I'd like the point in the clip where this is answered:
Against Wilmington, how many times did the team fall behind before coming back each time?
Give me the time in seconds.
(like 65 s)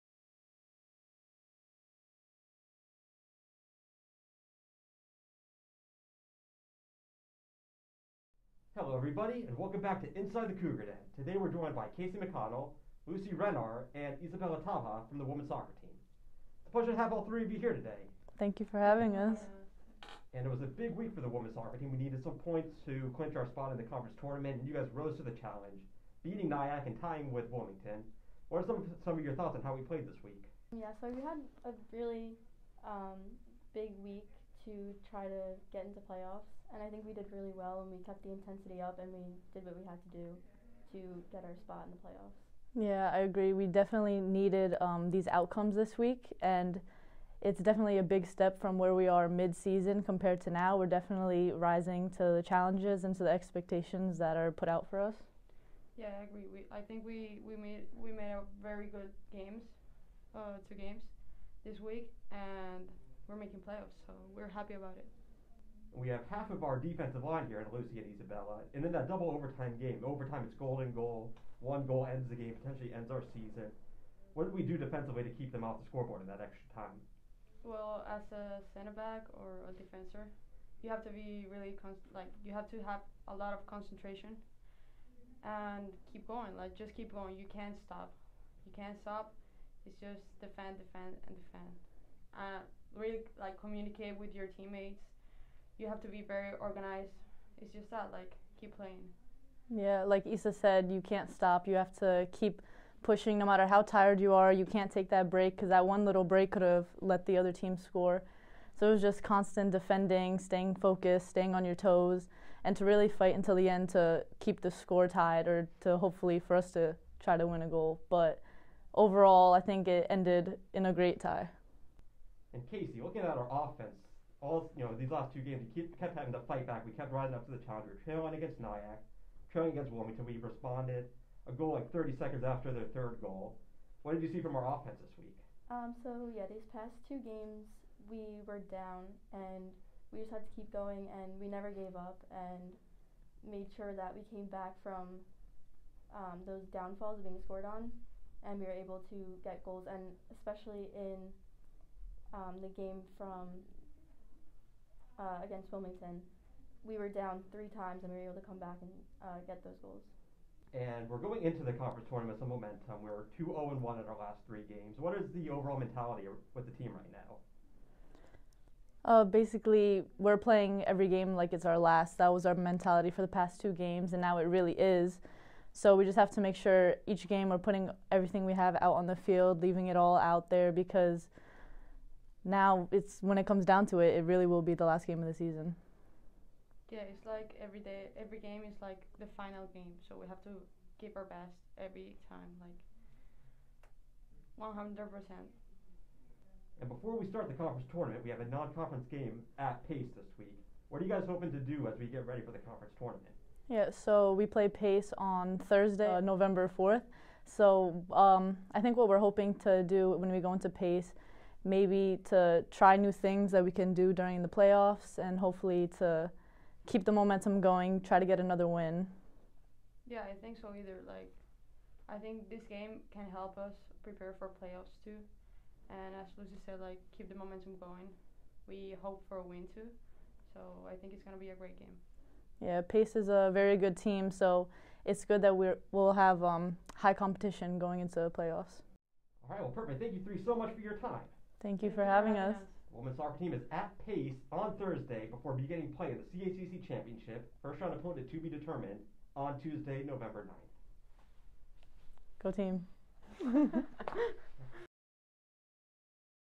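157 s.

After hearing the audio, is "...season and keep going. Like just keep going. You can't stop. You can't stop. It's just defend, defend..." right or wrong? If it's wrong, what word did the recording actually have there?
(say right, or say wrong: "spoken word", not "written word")
wrong: "concentration", not "season".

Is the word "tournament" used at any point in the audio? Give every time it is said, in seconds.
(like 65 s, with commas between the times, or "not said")
24 s, 162 s, 197 s, 202 s.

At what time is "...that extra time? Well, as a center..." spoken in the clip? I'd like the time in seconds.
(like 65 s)
76 s.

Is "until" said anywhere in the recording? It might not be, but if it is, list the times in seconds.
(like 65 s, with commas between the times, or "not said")
113 s.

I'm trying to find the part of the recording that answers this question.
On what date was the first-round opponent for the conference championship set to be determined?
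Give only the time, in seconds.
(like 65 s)
250 s.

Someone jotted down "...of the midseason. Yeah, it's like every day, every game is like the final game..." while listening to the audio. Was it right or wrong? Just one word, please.
wrong.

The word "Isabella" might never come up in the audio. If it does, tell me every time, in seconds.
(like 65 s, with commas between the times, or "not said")
14 s, 68 s.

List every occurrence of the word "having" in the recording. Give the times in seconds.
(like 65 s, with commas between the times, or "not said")
18 s, 126 s, 242 s.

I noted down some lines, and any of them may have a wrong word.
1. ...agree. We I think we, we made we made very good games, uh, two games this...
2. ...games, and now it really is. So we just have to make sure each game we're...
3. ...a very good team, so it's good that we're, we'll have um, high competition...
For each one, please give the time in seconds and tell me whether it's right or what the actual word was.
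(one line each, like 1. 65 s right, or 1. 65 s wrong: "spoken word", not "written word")
1. 56 s right
2. 173 s right
3. 233 s right.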